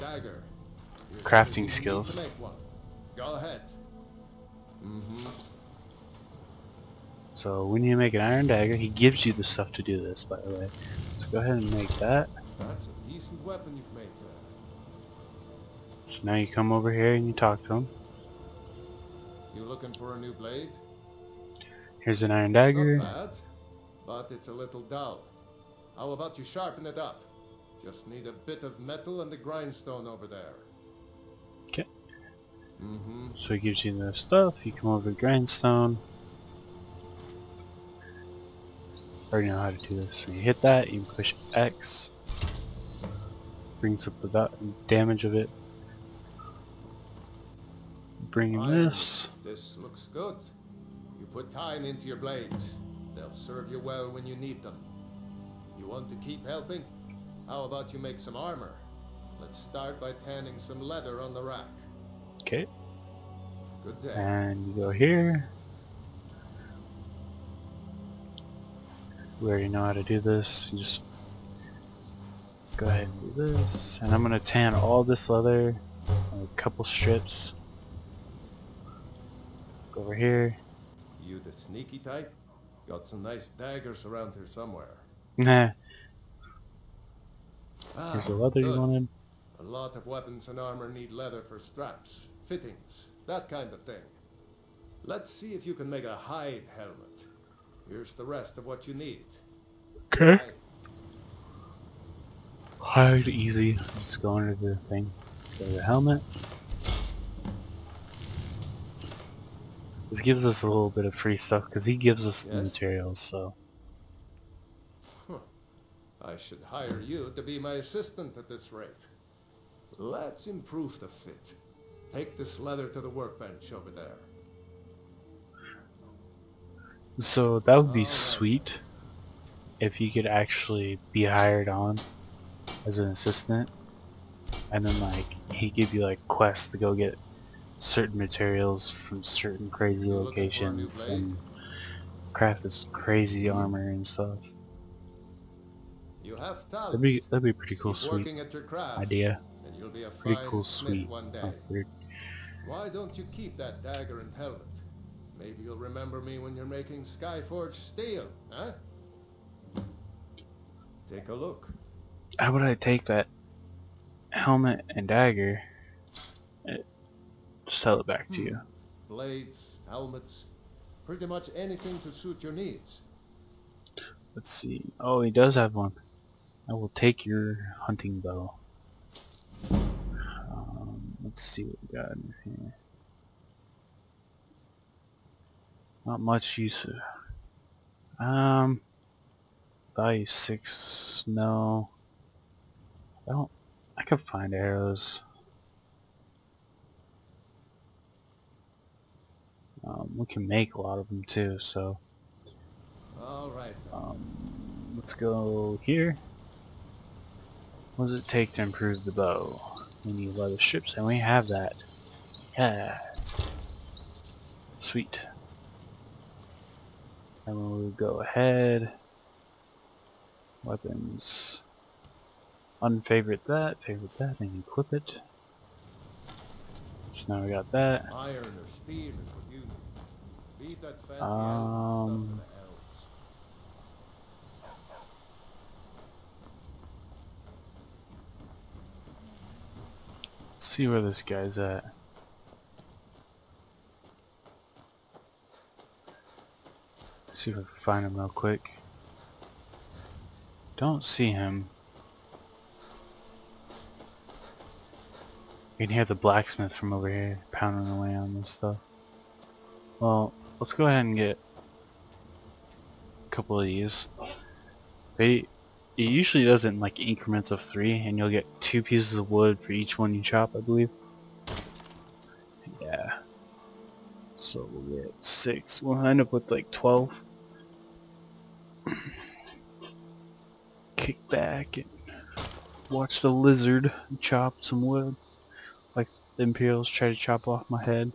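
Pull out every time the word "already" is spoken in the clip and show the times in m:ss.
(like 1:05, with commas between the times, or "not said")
0:39, 1:09.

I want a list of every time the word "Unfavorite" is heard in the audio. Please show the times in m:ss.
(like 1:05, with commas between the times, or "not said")
3:42.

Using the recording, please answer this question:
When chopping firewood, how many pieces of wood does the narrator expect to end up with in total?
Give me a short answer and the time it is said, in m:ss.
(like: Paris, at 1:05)
12, at 4:36.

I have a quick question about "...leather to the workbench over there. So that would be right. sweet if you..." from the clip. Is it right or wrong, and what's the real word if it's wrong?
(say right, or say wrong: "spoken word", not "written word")
right.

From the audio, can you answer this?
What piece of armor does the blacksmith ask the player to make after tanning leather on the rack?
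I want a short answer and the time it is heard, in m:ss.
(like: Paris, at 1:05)
Hide helmet, at 1:36.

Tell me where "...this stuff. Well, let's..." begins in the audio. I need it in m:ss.
4:18.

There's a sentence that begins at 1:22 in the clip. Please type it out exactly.
Got some nice daggers around here somewhere.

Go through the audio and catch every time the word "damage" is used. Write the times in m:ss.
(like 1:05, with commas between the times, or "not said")
0:44.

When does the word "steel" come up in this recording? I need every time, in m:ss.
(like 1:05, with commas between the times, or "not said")
2:37, 3:48.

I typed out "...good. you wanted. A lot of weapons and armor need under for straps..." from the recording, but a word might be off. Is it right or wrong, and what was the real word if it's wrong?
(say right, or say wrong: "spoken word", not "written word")
wrong: "leather", not "under".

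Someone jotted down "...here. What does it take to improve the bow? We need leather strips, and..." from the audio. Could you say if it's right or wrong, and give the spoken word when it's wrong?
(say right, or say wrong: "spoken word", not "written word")
right.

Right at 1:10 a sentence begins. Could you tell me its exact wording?
You just go ahead and do this.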